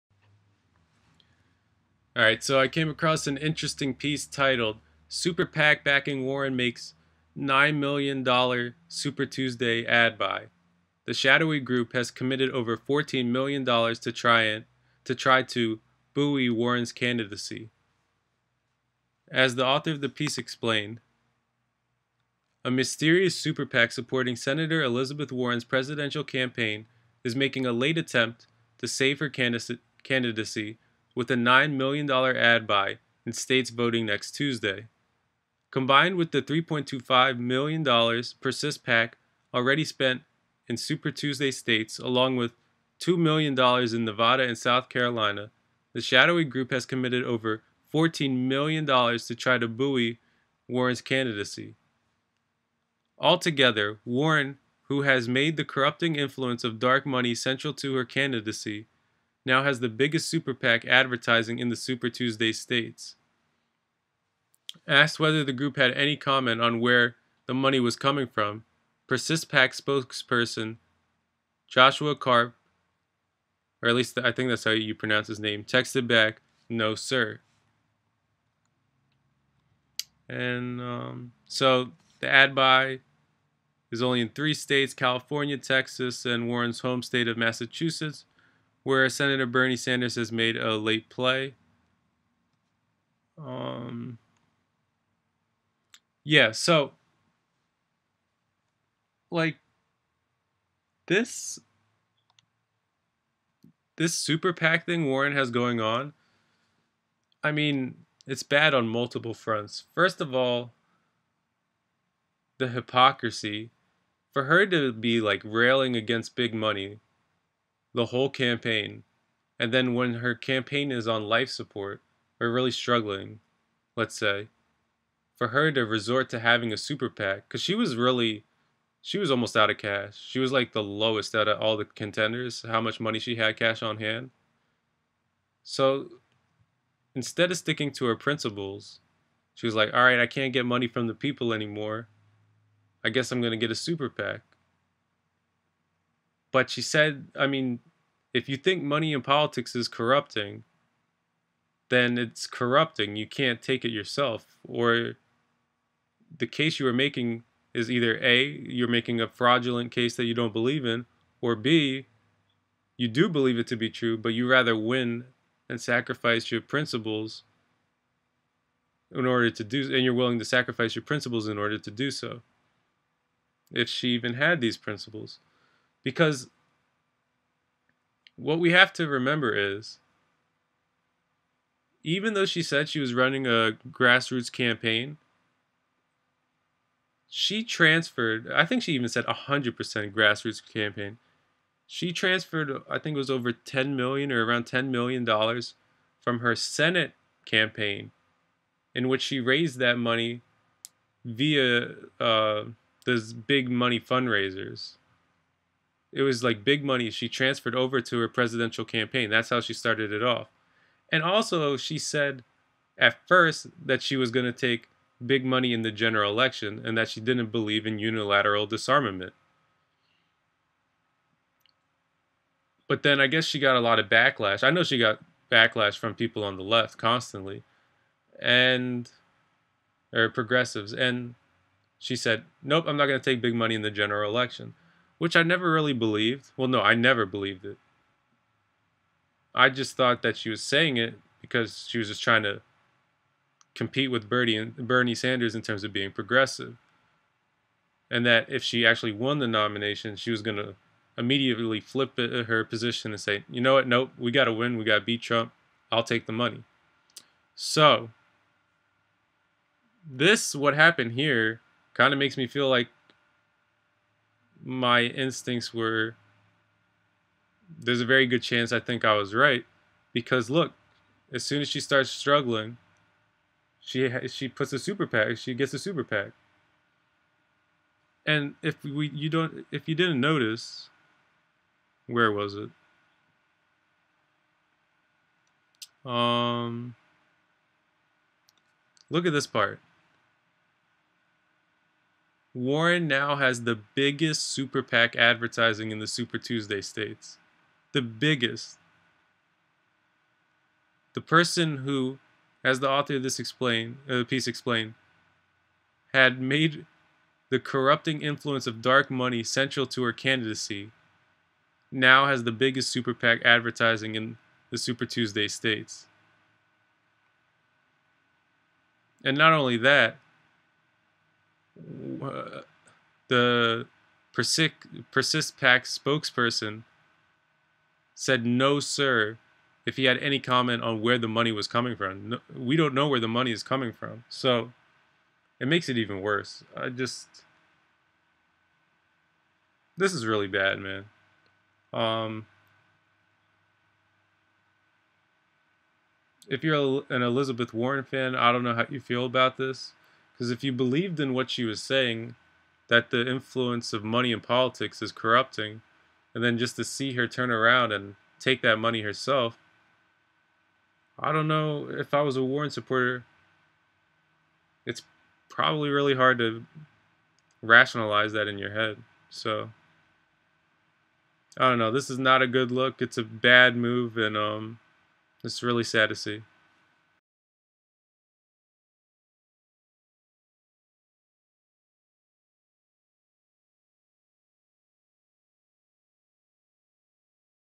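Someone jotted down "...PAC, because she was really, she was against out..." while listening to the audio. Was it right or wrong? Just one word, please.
wrong.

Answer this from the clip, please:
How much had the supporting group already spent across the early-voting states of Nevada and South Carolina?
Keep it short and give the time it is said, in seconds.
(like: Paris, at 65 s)
$2 million, at 43 s.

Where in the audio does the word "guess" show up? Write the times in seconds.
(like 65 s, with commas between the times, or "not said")
143 s, 223 s.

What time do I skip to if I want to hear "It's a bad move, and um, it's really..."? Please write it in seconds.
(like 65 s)
372 s.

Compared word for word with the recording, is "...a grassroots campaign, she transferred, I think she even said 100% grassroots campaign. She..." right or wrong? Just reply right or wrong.
right.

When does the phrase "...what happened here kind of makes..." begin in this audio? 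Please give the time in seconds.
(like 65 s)
260 s.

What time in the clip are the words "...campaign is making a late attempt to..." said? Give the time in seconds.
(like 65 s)
26 s.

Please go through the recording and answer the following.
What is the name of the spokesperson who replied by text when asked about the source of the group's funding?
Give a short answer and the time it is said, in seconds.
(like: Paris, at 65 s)
Joshua Karp, at 71 s.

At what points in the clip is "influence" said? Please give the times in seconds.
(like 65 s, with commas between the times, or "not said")
56 s, 308 s, 353 s.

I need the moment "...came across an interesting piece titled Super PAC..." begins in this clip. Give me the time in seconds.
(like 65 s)
2 s.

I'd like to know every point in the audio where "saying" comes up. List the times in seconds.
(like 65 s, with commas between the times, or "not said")
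240 s, 351 s.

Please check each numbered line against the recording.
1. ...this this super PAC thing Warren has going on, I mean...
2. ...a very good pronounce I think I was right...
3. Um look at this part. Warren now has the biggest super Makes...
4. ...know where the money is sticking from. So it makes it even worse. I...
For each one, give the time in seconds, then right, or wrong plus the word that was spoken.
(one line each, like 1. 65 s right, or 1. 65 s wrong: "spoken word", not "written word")
1. 101 s right
2. 268 s wrong: "chance", not "pronounce"
3. 286 s wrong: "PAC", not "Makes"
4. 332 s wrong: "coming", not "sticking".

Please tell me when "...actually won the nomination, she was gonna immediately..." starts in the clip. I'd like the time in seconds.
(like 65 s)
248 s.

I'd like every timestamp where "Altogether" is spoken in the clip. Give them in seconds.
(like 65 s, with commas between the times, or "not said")
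53 s.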